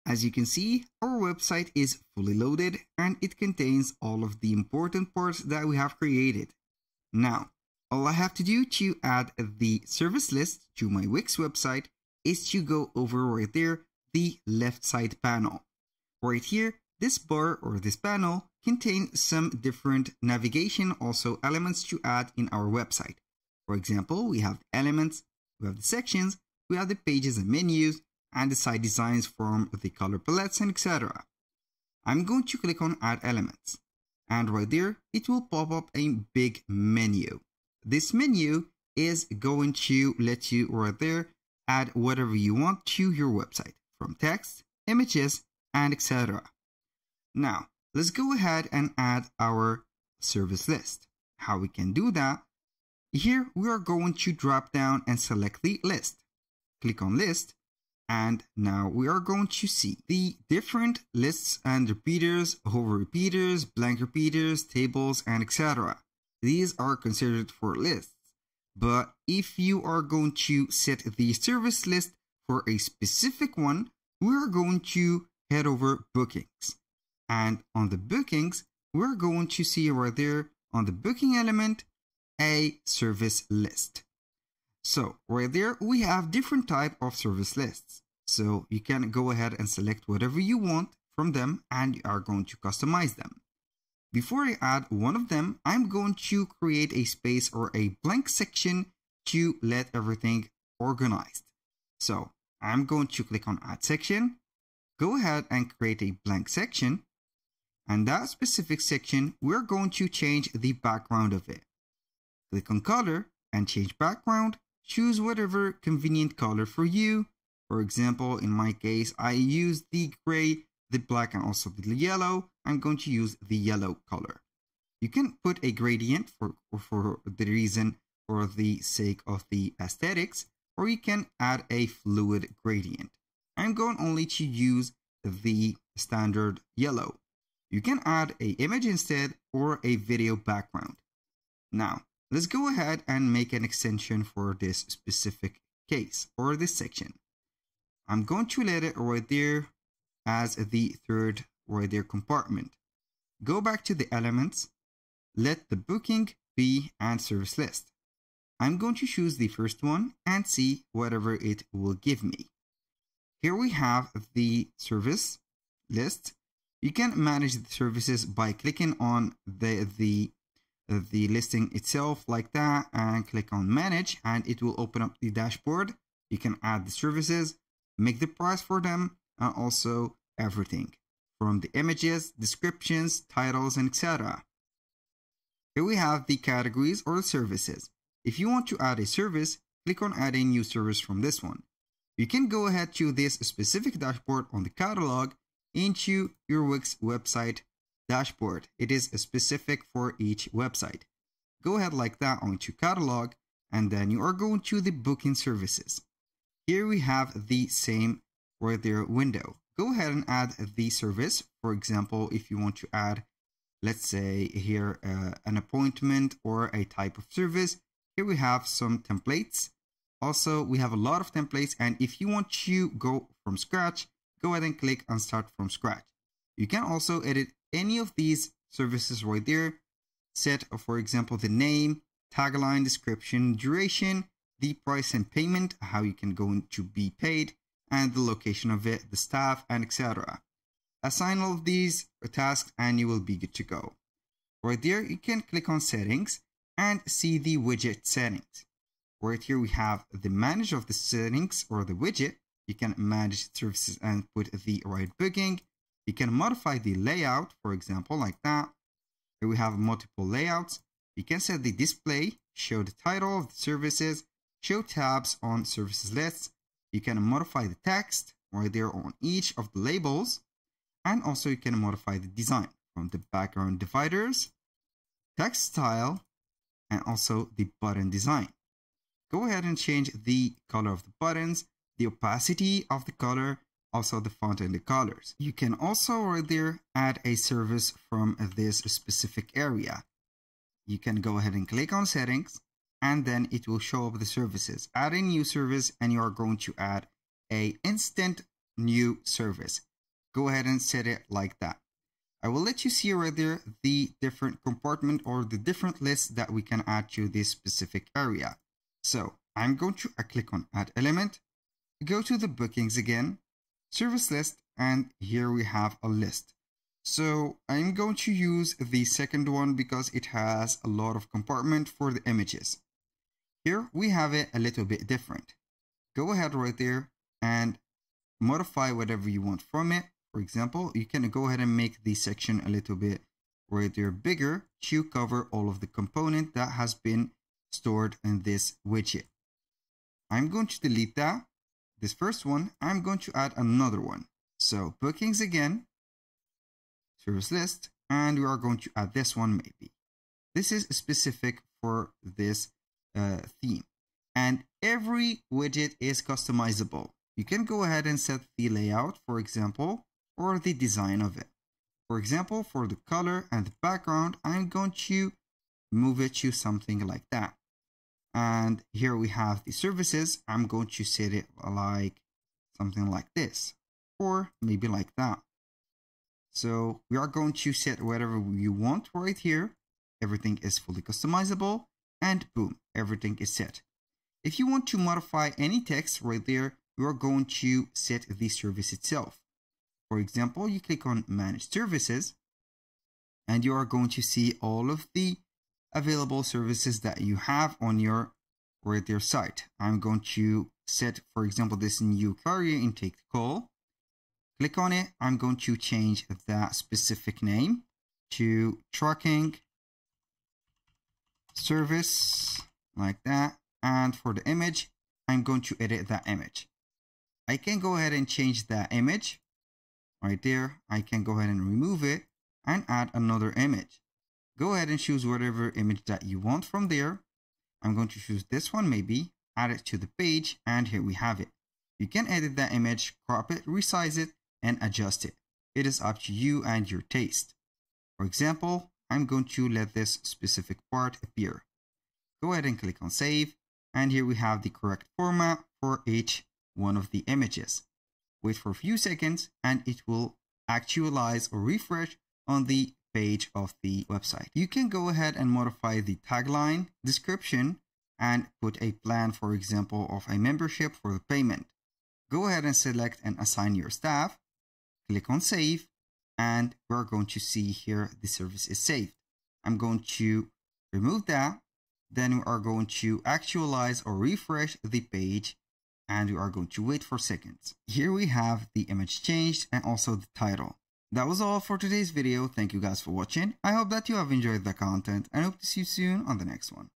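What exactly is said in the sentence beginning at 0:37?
This menu is going to let you right there add whatever you want to your website from text, images and etc.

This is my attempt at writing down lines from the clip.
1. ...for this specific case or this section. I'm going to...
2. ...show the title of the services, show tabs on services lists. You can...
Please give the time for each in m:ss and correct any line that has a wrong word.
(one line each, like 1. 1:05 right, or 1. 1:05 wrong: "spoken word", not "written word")
1. 2:24 right
2. 4:22 right.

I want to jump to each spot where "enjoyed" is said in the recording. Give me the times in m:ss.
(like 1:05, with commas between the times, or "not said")
8:04.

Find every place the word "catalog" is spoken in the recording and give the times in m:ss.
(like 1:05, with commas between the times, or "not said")
3:14, 3:22.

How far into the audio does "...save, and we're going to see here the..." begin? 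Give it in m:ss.
7:45.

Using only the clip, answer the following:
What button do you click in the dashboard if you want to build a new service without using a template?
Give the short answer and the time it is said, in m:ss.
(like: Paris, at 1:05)
Start from scratch, at 3:45.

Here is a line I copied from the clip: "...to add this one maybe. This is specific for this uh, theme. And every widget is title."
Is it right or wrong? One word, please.
wrong.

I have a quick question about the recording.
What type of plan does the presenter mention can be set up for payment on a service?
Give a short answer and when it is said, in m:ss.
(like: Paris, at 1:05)
Membership, at 7:40.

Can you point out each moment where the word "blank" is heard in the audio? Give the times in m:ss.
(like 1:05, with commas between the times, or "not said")
1:03, 1:38, 1:46.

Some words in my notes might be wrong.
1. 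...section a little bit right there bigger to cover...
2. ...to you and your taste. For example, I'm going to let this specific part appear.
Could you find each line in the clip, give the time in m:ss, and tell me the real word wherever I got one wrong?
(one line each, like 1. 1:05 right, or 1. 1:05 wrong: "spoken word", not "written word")
1. 5:32 right
2. 7:16 right.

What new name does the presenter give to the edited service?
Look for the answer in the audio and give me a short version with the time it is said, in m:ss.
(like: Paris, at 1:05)
Tracking service, at 6:48.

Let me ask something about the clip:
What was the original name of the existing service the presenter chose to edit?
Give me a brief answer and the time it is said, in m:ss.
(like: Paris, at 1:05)
New carrier intake call, at 6:42.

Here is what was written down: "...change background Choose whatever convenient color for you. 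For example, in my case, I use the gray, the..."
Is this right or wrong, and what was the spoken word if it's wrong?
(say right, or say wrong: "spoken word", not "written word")
right.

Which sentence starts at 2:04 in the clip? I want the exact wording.
You can put a gradient for, for the reason for the sake of the aesthetics, or you can add a fluid gradient.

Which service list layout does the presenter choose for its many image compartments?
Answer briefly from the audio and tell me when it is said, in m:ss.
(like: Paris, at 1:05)
The second one, at 5:18.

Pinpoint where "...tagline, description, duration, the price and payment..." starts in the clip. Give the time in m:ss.
3:52.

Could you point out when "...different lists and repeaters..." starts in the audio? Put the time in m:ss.
1:00.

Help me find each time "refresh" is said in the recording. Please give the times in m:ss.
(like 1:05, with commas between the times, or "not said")
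7:31, 7:54.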